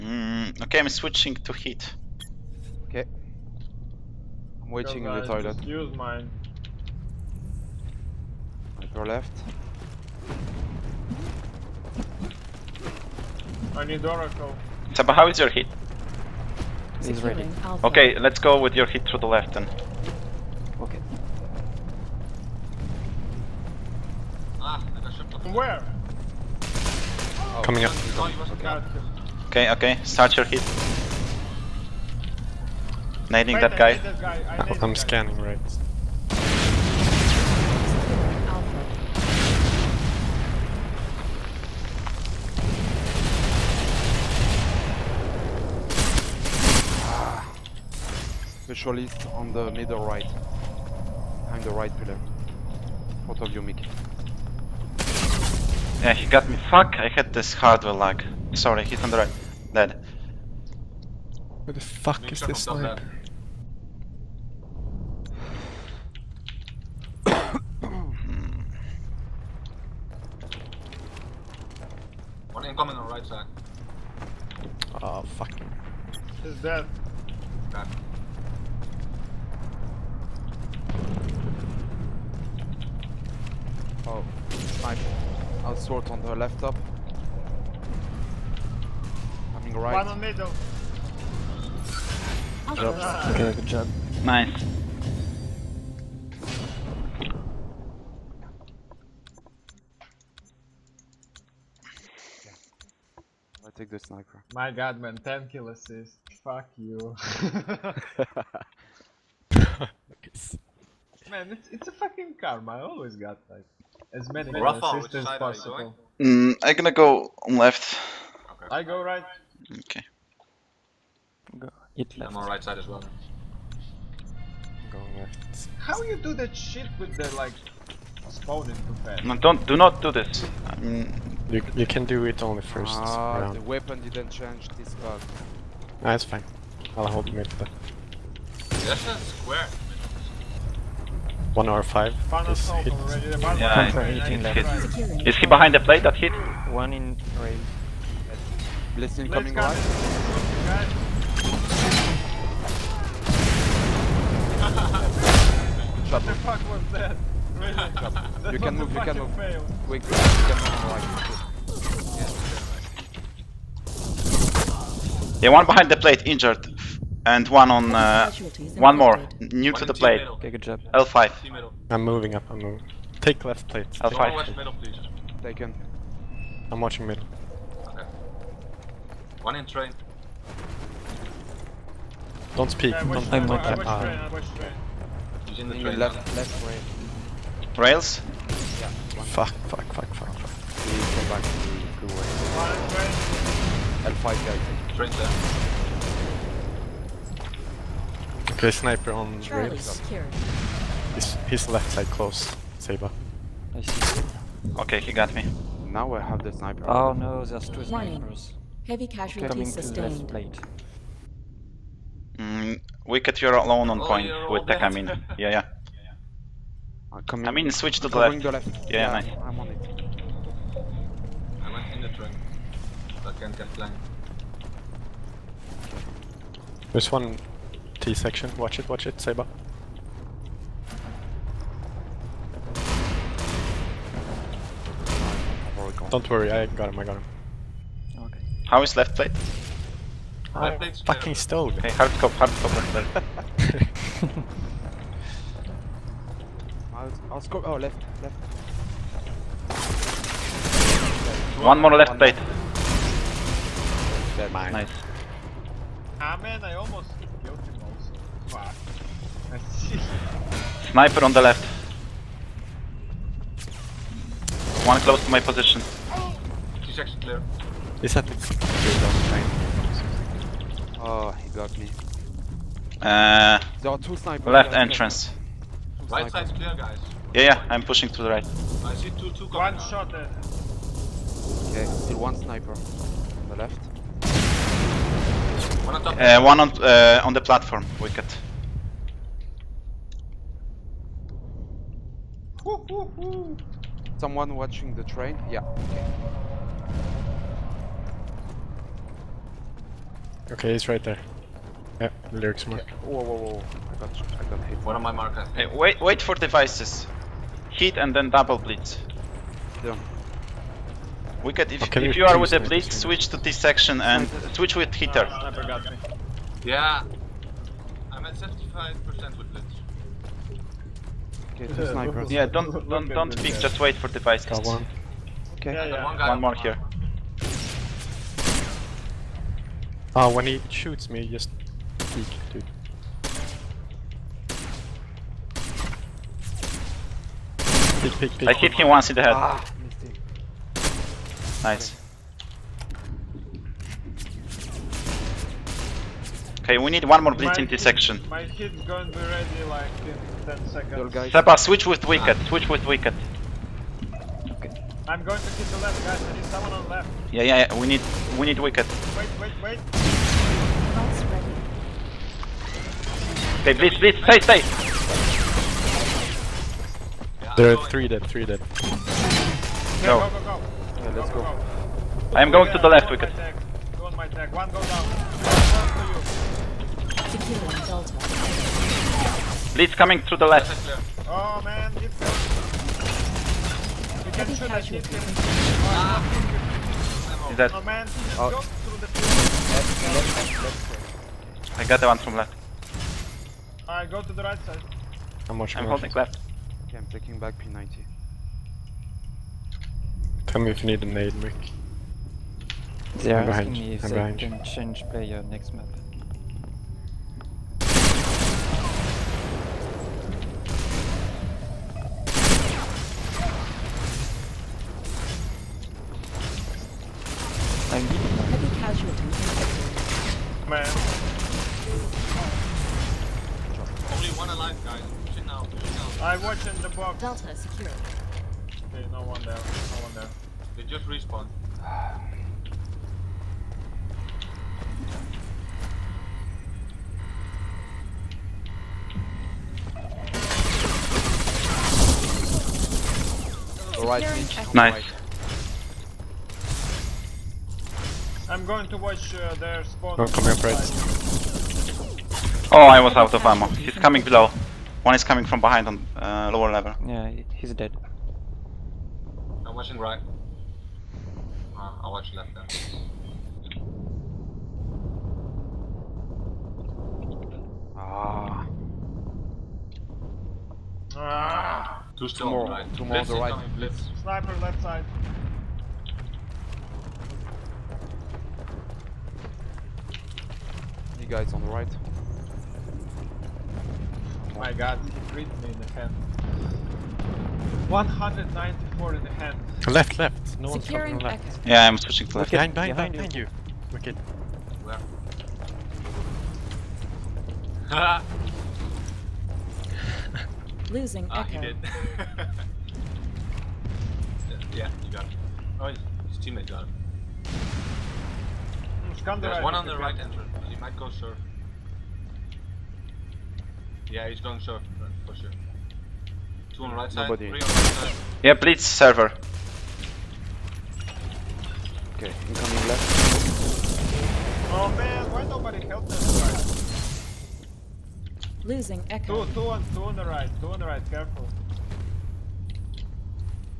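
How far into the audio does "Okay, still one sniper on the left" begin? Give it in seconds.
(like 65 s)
280 s.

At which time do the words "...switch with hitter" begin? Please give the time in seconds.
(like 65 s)
314 s.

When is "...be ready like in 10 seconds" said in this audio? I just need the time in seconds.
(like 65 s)
349 s.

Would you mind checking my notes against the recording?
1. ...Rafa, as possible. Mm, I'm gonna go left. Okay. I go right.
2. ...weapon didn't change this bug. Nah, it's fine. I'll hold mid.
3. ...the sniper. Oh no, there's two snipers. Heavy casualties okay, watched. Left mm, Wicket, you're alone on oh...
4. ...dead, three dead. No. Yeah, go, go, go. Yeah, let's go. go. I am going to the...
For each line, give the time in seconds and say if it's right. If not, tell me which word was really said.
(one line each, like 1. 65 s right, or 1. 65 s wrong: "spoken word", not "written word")
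1. 114 s right
2. 133 s right
3. 206 s wrong: "sustained", not "watched"
4. 368 s right.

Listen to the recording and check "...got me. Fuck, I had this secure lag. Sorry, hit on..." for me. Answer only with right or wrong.
wrong.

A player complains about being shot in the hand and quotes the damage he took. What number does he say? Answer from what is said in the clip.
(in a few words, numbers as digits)
194.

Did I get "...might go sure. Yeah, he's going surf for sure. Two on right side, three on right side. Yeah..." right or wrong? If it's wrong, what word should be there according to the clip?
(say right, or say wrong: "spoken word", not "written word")
right.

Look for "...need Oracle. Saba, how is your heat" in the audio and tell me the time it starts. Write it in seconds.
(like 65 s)
13 s.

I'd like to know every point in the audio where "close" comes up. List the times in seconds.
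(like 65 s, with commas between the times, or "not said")
202 s, 265 s.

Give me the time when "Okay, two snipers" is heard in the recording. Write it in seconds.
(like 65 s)
321 s.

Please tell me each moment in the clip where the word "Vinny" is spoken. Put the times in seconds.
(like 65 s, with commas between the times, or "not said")
not said.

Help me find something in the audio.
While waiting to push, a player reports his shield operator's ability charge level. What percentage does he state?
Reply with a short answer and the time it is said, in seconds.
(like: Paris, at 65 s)
75%, at 318 s.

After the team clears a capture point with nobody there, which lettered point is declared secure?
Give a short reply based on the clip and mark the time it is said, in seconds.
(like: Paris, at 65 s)
Delta, at 427 s.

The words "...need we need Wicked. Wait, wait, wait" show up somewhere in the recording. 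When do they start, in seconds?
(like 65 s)
357 s.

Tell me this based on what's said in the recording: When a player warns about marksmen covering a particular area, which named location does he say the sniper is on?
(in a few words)
Charlie rails.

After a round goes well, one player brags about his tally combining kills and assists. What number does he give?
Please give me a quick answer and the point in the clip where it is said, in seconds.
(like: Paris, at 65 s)
10, at 105 s.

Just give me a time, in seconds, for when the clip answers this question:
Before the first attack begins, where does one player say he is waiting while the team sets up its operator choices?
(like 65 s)
5 s.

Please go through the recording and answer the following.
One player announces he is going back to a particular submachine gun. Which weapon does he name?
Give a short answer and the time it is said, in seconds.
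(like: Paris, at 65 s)
P90, at 397 s.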